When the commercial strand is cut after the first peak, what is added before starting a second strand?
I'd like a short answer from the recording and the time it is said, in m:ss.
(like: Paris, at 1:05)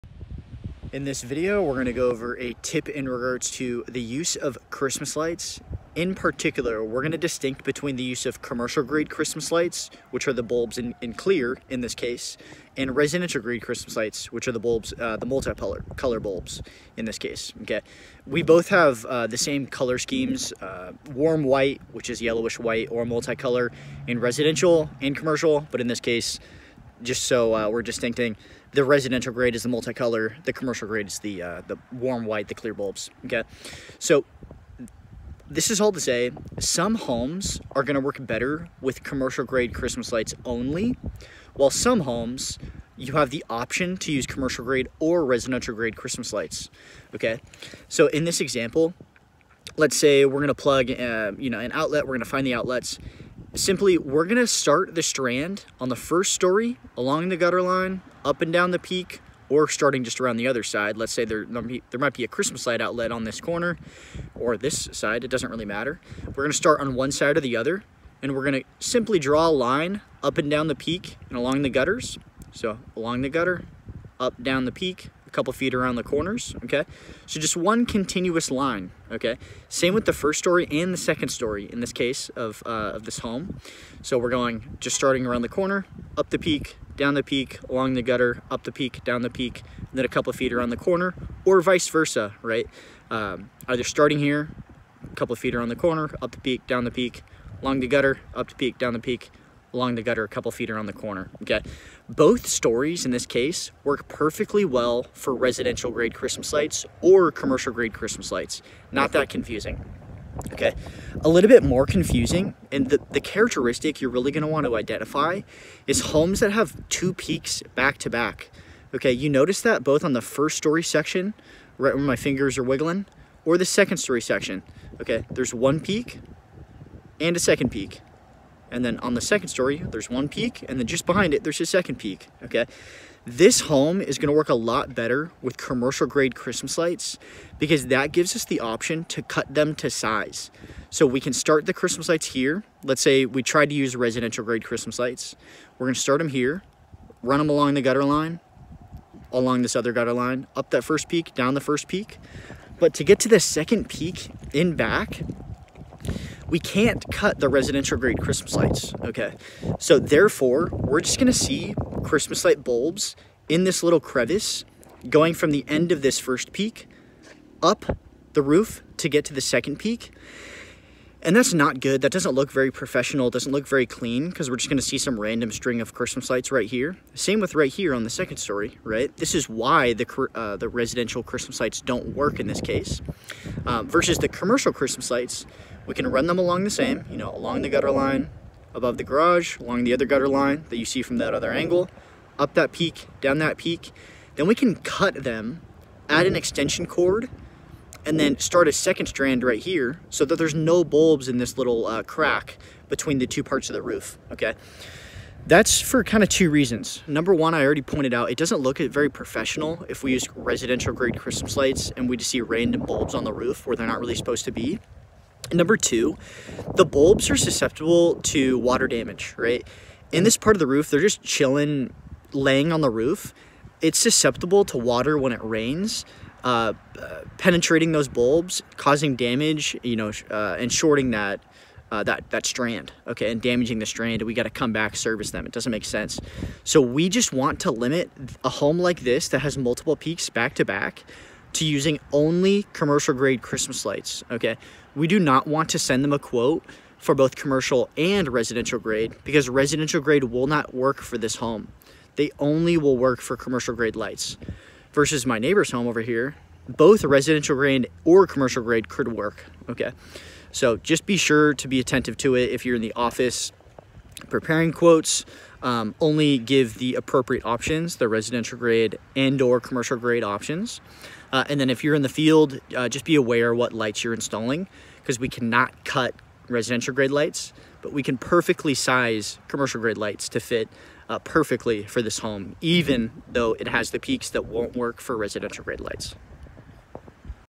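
An extension cord, at 3:16.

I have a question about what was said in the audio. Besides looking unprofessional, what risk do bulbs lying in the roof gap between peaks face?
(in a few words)
Water damage.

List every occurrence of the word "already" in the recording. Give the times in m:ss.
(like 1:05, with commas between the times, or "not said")
3:27.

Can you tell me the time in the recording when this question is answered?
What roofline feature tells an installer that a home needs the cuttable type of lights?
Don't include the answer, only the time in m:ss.
1:56.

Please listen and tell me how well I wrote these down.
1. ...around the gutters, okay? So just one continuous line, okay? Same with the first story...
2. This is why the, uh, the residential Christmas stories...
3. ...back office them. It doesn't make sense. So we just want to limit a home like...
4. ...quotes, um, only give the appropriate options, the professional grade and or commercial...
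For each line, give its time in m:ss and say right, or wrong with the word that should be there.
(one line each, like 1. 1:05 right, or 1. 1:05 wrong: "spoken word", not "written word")
1. 1:15 wrong: "corners", not "gutters"
2. 2:59 wrong: "sites", not "stories"
3. 3:54 wrong: "service", not "office"
4. 4:24 wrong: "residential", not "professional".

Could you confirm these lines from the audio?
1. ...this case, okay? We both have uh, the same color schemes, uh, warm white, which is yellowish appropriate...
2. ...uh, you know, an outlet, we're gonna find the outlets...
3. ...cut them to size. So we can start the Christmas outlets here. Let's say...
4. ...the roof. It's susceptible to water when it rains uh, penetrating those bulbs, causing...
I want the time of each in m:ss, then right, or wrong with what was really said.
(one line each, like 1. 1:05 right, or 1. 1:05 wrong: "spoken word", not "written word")
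1. 0:17 wrong: "white", not "appropriate"
2. 0:50 right
3. 2:19 wrong: "lights", not "outlets"
4. 3:42 right.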